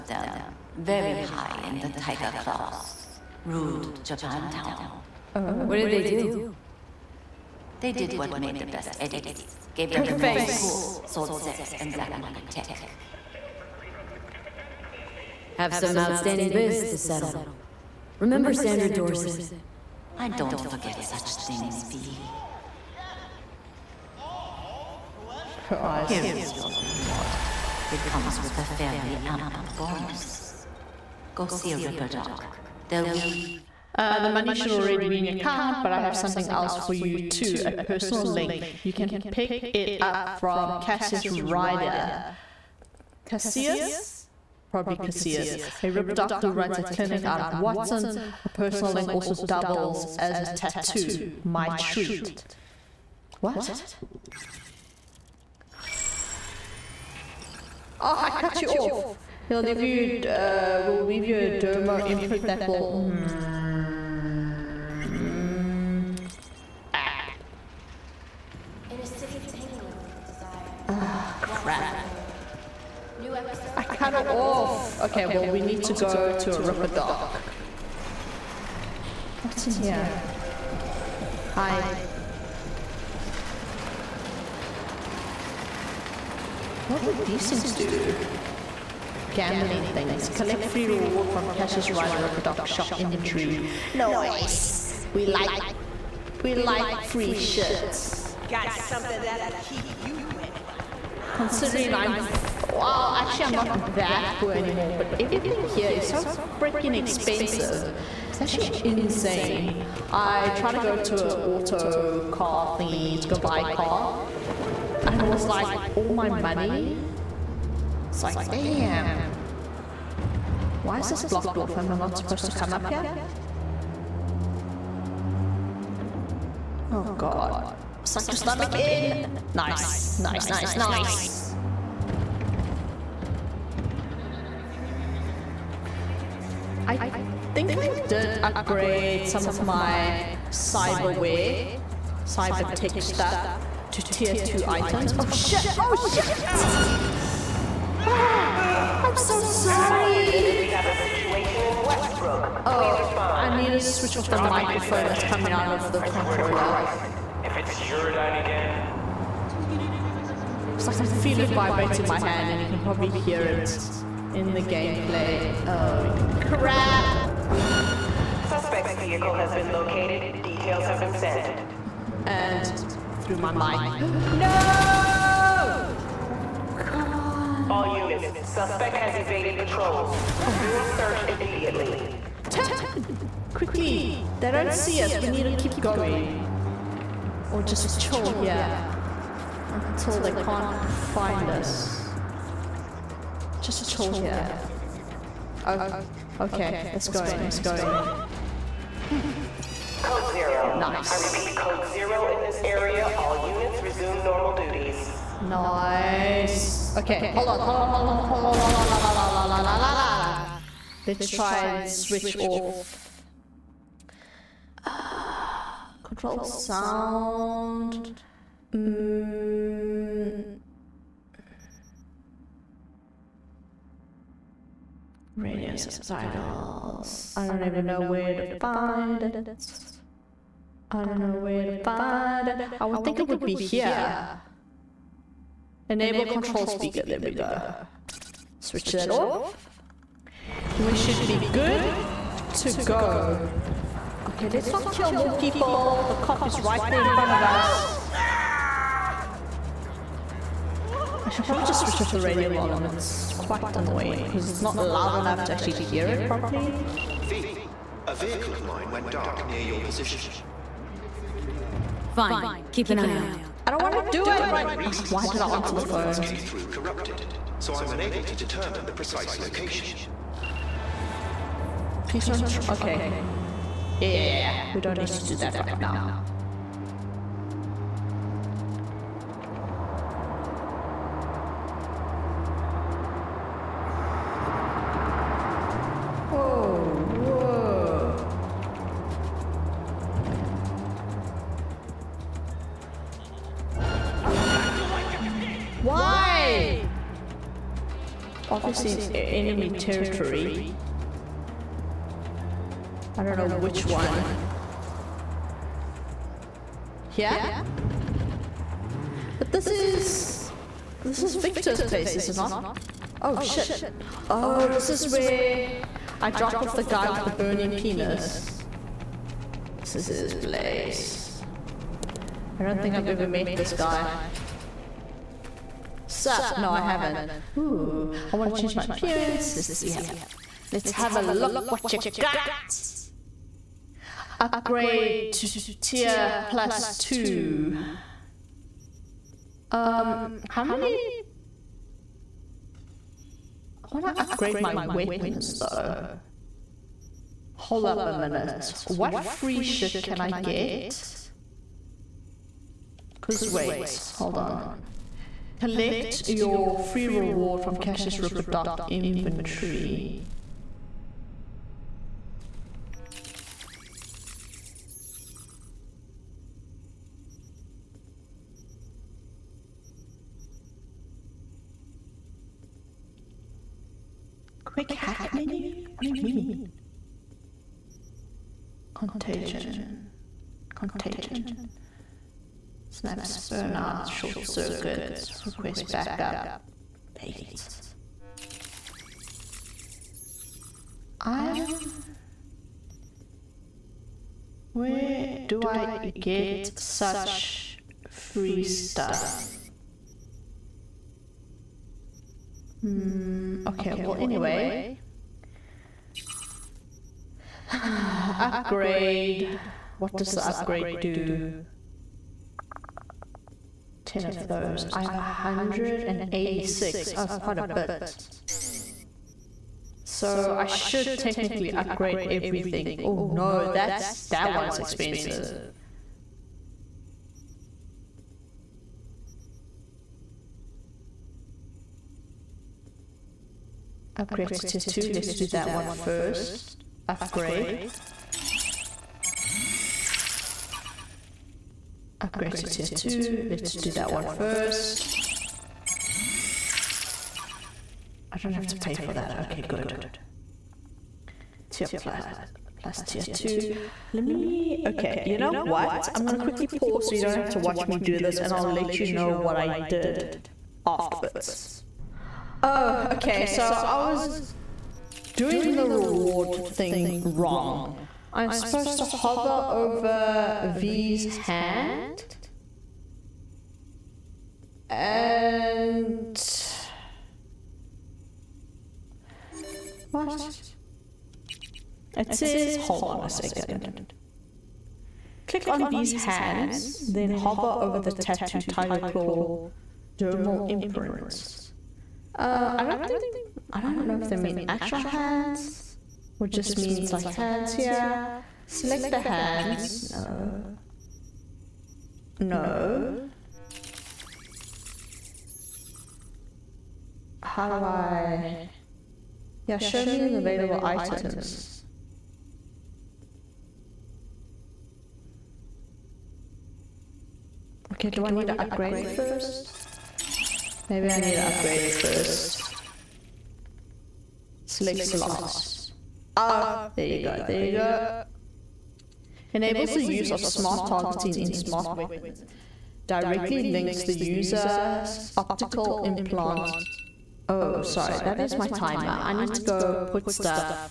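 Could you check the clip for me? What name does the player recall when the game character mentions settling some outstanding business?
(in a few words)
Sandra Dorsett.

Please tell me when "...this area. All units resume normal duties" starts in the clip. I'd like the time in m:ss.
3:22.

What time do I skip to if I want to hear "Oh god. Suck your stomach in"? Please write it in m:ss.
2:06.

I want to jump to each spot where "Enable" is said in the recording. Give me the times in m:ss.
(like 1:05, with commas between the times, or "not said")
3:55, 8:49.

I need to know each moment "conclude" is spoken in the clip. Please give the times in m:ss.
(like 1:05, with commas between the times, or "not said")
not said.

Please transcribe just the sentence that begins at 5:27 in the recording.
Ooh, I want to change my appearance.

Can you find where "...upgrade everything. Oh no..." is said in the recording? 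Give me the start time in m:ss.
7:01.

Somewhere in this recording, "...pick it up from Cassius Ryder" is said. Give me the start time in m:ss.
0:39.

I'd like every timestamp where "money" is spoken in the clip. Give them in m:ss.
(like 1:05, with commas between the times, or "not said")
0:34, 1:56.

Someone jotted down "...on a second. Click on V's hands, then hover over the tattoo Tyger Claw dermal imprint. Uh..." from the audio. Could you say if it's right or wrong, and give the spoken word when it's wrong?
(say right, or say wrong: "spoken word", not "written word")
right.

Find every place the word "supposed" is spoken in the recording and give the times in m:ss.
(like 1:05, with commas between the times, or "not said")
2:02, 7:48.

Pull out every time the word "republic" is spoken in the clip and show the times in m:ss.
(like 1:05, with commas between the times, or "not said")
not said.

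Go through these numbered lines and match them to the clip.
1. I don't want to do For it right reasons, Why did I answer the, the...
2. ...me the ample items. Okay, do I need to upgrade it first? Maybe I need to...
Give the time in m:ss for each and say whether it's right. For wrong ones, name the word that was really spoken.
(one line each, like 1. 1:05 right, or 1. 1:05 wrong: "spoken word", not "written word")
1. 4:23 right
2. 8:30 wrong: "available", not "ample".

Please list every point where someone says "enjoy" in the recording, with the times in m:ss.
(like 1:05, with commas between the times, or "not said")
not said.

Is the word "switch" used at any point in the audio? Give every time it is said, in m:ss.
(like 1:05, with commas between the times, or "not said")
2:33, 3:31, 3:58, 4:11.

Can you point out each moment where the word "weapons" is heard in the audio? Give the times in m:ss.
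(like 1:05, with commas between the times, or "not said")
5:44, 8:51.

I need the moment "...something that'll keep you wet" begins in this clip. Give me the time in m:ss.
1:38.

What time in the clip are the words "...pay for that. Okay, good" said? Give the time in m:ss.
7:28.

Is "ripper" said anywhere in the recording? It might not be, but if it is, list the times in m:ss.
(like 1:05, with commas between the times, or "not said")
0:31, 0:45, 1:16, 5:58.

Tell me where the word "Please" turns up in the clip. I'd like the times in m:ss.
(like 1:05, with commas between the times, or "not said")
2:32, 4:32.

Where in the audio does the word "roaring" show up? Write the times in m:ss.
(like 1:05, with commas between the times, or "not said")
not said.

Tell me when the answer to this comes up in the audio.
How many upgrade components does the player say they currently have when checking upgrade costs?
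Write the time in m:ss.
6:55.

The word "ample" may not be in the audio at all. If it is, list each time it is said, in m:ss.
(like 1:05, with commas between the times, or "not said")
0:29.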